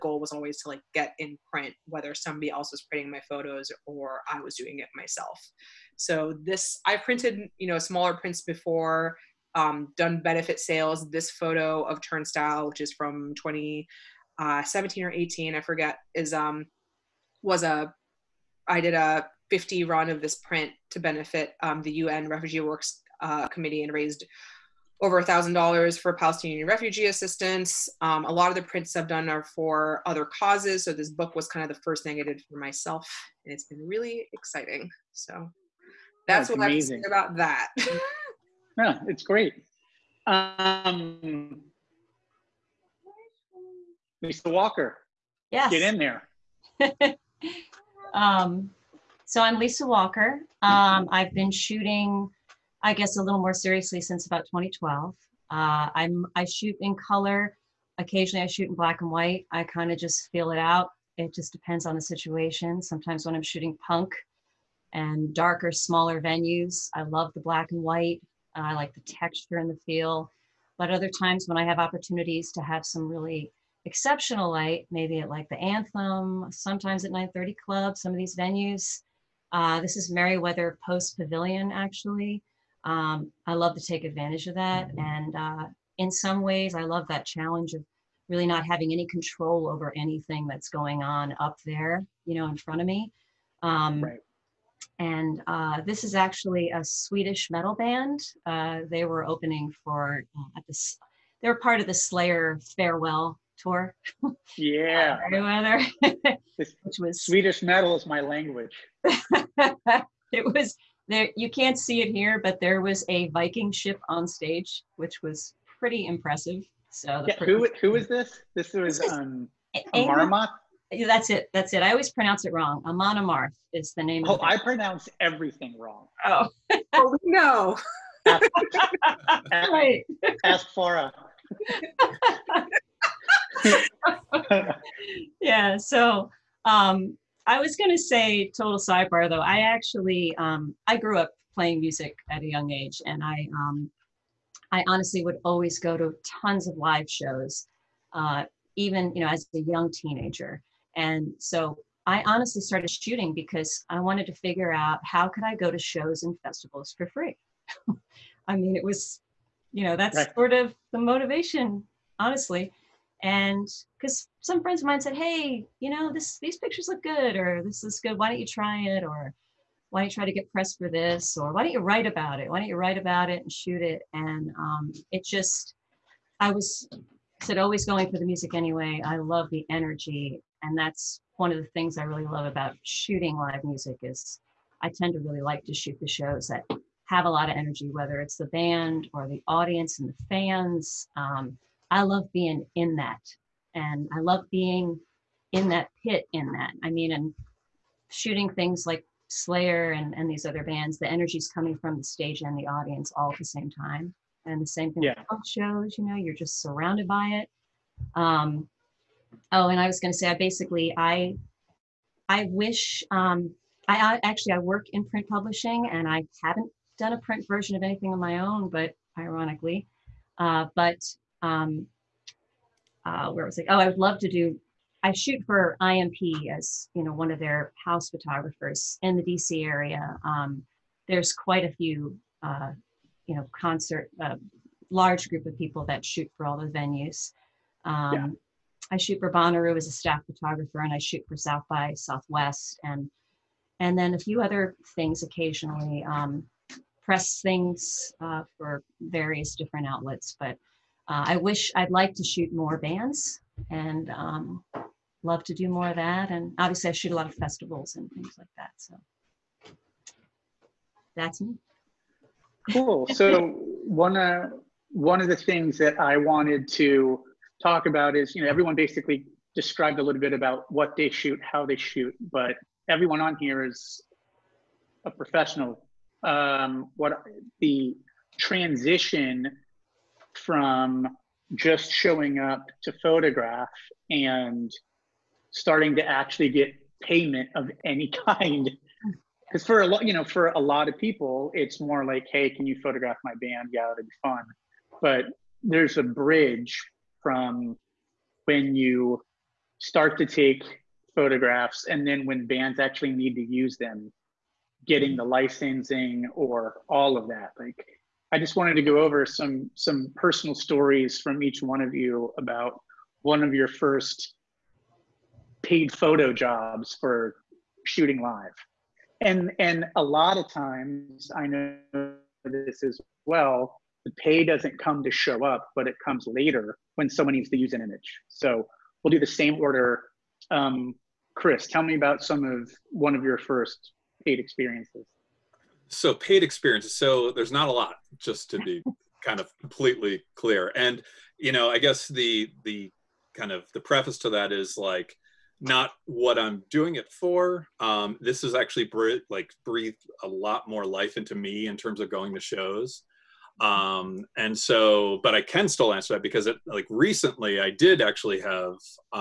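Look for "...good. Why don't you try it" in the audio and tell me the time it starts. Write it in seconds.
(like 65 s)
168 s.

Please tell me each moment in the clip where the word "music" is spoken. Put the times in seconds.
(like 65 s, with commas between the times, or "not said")
141 s, 178 s, 183 s.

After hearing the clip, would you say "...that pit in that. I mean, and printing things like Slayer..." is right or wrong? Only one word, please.
wrong.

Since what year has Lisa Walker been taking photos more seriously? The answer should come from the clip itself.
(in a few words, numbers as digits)
2012.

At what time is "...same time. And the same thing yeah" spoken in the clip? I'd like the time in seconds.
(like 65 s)
203 s.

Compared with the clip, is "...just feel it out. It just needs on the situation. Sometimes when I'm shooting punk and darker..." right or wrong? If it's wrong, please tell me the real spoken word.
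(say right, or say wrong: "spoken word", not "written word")
wrong: "depends", not "needs".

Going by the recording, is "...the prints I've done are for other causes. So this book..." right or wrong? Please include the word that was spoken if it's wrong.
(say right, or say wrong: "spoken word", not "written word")
right.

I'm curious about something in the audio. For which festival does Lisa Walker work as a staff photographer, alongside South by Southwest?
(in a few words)
Bonnaroo.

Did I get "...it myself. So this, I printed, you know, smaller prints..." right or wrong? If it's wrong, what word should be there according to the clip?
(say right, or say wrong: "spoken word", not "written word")
right.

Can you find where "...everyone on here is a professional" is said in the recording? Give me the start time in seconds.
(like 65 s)
272 s.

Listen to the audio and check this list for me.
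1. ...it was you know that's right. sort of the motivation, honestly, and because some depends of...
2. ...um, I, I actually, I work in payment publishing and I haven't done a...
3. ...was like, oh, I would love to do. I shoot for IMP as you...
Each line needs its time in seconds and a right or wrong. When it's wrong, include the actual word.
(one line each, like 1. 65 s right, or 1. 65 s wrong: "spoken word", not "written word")
1. 158 s wrong: "friends", not "depends"
2. 213 s wrong: "print", not "payment"
3. 223 s right.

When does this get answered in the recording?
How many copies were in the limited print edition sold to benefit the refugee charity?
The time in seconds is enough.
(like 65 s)
19 s.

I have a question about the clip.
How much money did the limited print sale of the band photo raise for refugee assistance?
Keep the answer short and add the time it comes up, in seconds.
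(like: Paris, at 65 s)
over $1,000, at 25 s.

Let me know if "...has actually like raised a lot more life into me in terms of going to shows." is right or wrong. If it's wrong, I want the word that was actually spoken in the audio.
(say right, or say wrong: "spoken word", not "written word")
wrong: "breathed", not "raised".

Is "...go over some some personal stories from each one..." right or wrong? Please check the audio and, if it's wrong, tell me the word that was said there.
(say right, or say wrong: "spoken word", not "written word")
right.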